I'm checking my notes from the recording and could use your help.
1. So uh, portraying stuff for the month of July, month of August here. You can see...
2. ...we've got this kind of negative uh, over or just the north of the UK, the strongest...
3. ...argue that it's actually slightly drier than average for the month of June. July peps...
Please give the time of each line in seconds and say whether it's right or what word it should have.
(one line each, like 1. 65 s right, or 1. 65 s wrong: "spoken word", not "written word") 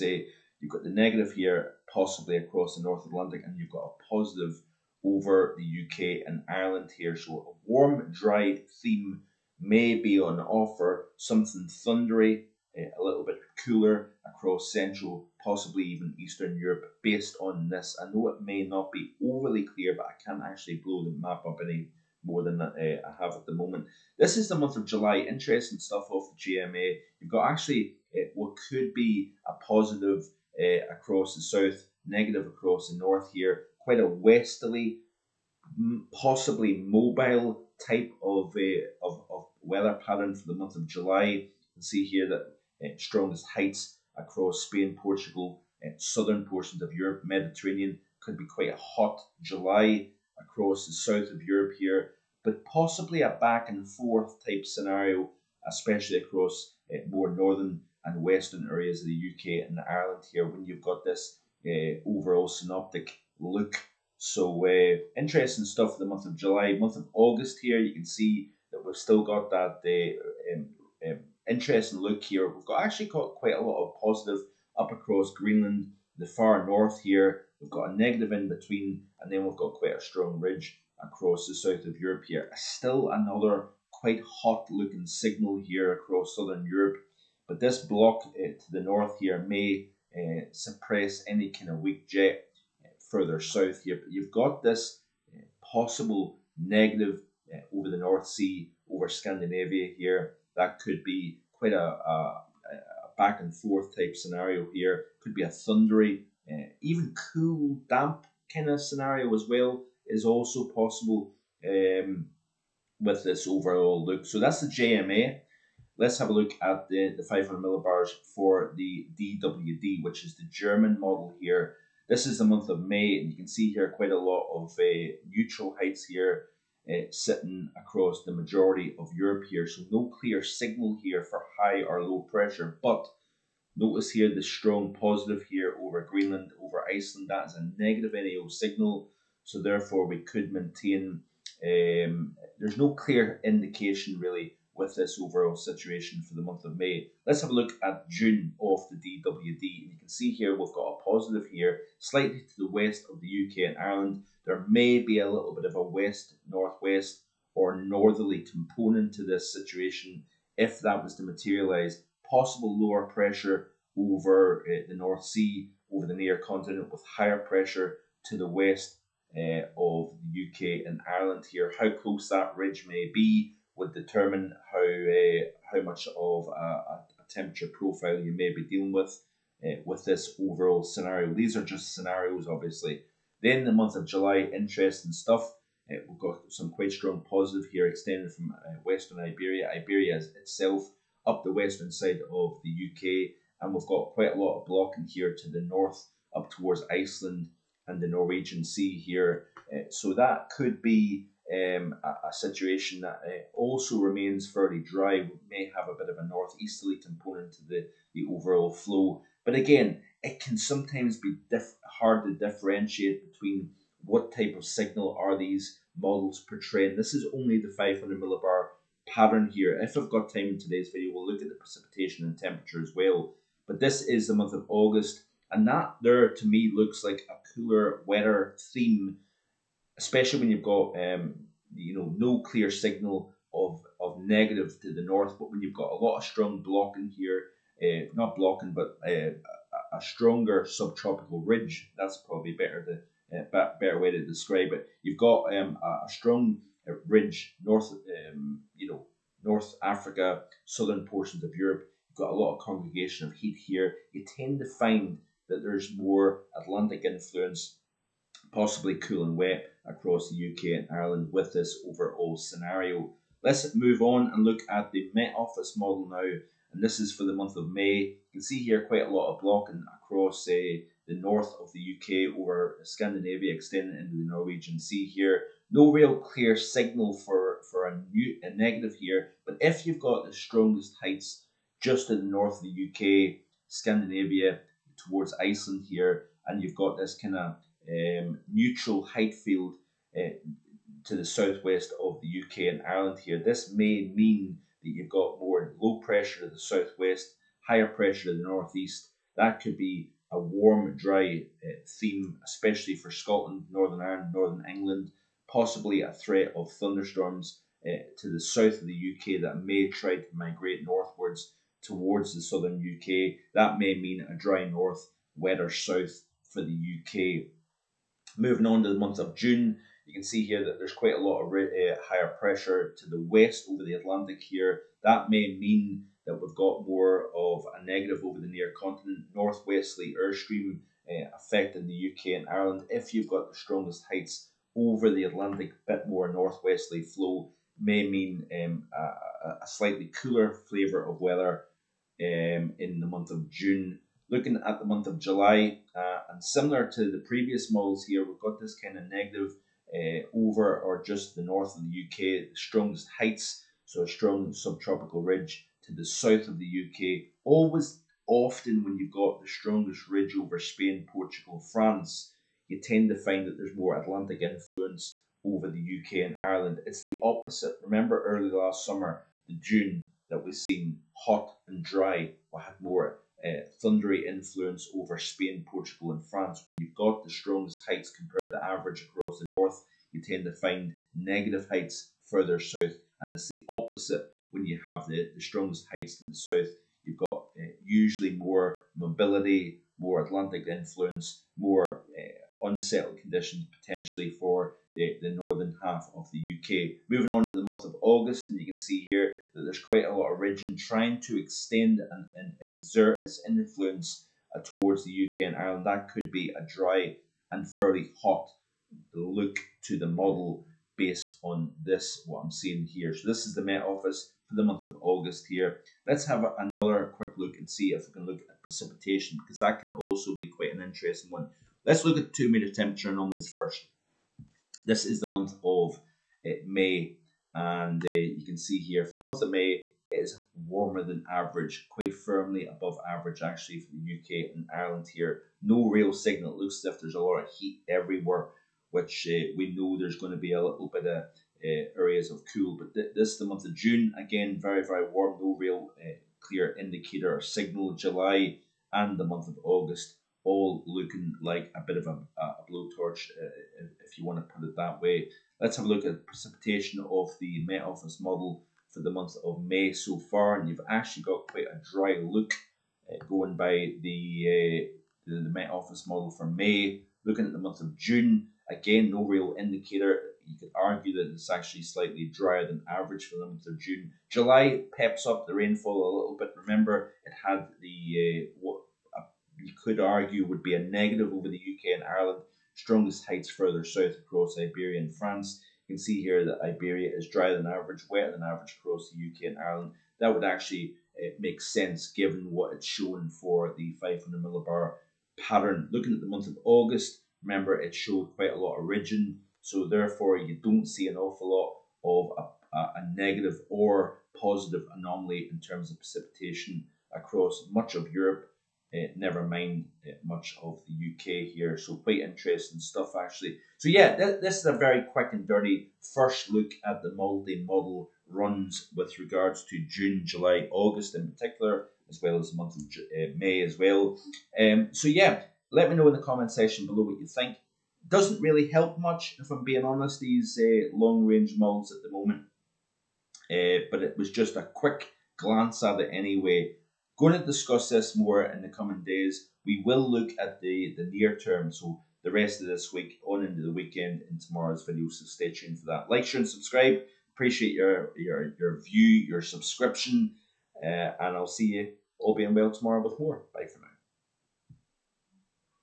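1. 64 s wrong: "interesting", not "portraying"
2. 348 s right
3. 470 s right.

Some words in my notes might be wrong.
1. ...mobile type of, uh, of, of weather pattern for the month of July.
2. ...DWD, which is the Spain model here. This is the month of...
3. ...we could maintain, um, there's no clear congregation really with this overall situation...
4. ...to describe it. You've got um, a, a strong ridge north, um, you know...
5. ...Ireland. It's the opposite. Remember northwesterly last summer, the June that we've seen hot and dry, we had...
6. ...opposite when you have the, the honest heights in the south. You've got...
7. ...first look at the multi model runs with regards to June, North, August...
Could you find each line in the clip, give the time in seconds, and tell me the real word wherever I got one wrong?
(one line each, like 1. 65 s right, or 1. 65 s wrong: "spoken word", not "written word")
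1. 36 s right
2. 119 s wrong: "German", not "Spain"
3. 140 s wrong: "indication", not "congregation"
4. 244 s right
5. 366 s wrong: "early", not "northwesterly"
6. 383 s wrong: "strongest", not "honest"
7. 516 s wrong: "July", not "North".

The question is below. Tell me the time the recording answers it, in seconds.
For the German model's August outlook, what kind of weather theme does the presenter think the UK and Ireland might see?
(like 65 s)
227 s.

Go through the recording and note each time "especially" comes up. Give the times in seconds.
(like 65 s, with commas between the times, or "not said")
55 s, 229 s, 302 s.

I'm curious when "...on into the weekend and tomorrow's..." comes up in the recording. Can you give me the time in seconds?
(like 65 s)
543 s.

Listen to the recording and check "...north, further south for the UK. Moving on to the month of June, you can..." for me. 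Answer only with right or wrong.
wrong.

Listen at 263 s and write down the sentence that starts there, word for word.
Let's move on and look at the Met Office model now, and this is for the month of May.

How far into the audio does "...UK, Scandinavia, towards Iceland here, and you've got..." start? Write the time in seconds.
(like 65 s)
283 s.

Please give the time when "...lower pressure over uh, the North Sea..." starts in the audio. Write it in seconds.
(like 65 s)
162 s.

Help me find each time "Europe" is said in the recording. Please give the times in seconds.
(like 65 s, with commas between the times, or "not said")
16 s, 46 s, 51 s, 81 s, 86 s, 129 s, 251 s, 508 s.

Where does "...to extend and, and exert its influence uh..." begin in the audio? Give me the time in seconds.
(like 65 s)
401 s.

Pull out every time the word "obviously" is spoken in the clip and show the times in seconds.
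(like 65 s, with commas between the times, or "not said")
182 s.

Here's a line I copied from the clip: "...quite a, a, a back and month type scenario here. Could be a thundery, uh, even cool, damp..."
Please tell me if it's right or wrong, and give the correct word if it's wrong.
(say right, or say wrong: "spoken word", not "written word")
wrong: "forth", not "month".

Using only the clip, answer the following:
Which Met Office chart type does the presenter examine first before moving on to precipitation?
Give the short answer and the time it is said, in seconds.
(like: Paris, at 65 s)
Two meter temperature anomalies, at 422 s.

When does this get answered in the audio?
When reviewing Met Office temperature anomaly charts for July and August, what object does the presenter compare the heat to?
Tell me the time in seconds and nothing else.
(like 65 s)
452 s.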